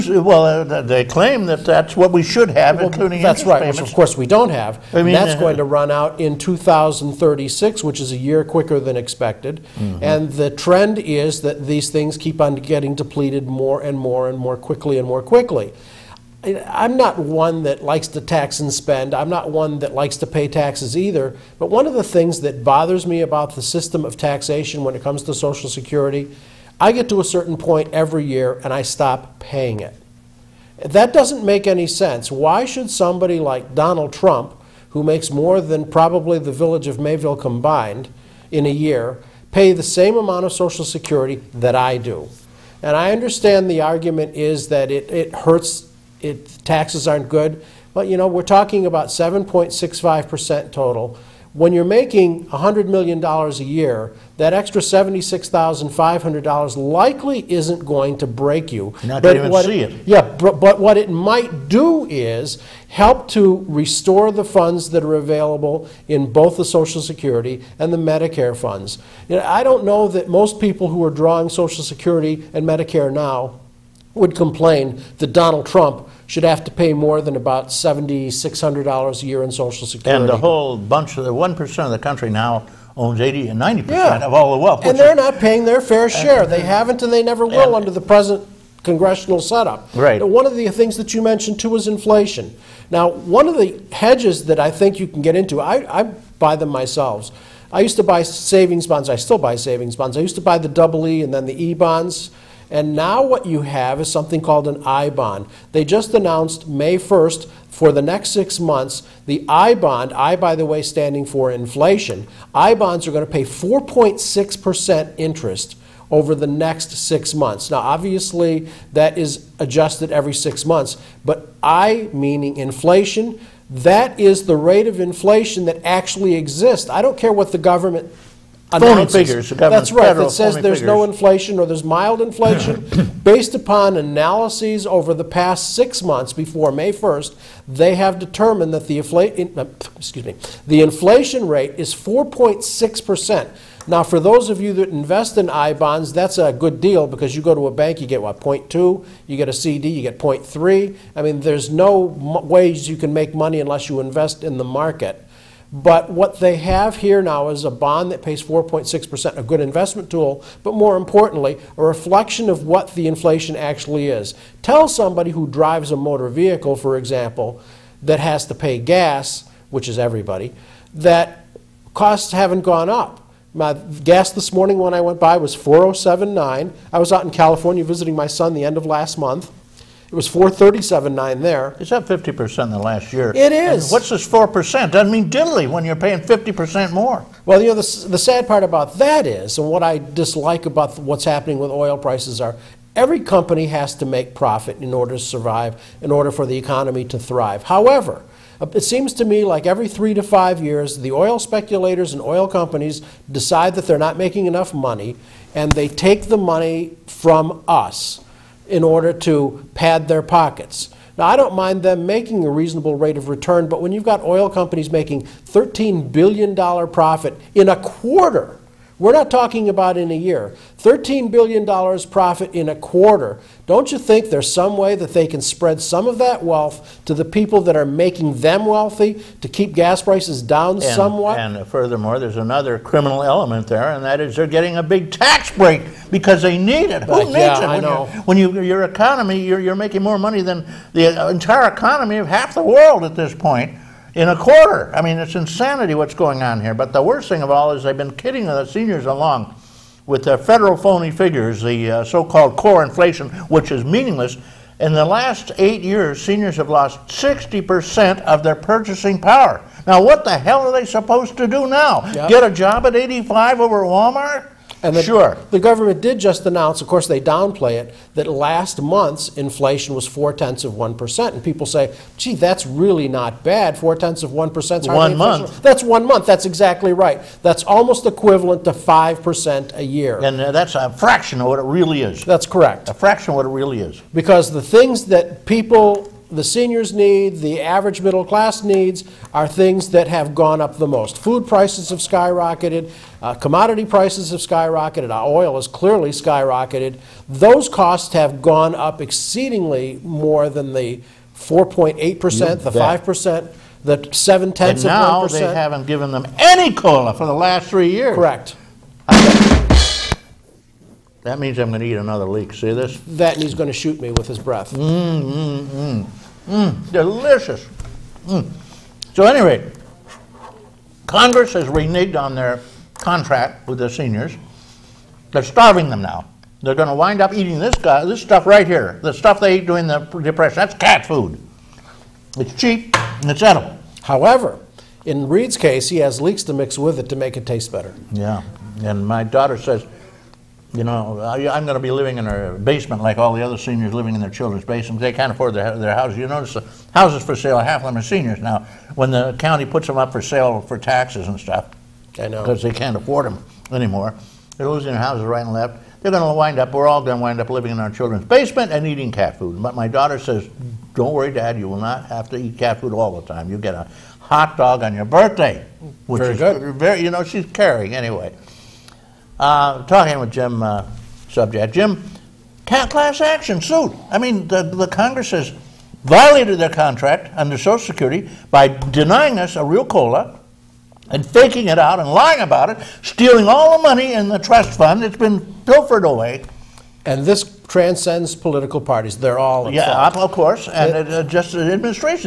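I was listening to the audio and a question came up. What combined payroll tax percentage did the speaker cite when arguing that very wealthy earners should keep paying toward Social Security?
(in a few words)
7.65%.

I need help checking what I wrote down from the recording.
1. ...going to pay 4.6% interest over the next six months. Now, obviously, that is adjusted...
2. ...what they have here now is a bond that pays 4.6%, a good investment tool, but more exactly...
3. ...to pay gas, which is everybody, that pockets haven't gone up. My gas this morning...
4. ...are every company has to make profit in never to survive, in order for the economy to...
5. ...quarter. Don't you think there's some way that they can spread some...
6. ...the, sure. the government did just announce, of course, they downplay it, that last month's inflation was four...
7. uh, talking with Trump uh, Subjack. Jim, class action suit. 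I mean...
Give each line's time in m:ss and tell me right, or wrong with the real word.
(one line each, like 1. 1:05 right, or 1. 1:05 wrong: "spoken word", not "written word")
1. 1:53 right
2. 2:36 wrong: "importantly", not "exactly"
3. 2:48 wrong: "costs", not "pockets"
4. 3:12 wrong: "order", not "never"
5. 3:42 right
6. 4:24 right
7. 6:09 wrong: "Jim", not "Trump".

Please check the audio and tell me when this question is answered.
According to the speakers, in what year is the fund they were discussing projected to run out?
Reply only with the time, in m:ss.
0:06.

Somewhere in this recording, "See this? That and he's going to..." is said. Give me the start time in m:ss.
5:12.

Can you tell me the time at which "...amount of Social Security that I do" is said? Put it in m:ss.
0:40.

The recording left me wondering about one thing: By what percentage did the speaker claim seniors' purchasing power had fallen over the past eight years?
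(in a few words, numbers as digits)
60%.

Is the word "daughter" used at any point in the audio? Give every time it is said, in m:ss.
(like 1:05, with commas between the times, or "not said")
5:39, 5:59.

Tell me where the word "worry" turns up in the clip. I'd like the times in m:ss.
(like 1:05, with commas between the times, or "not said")
6:01.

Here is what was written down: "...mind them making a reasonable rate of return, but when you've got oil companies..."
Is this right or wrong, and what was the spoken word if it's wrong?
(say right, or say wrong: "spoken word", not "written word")
right.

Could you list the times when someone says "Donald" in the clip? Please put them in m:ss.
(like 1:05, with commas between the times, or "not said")
0:33, 1:15.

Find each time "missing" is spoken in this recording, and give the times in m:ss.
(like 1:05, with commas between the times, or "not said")
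not said.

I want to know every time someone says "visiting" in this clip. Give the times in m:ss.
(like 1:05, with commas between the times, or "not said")
2:57.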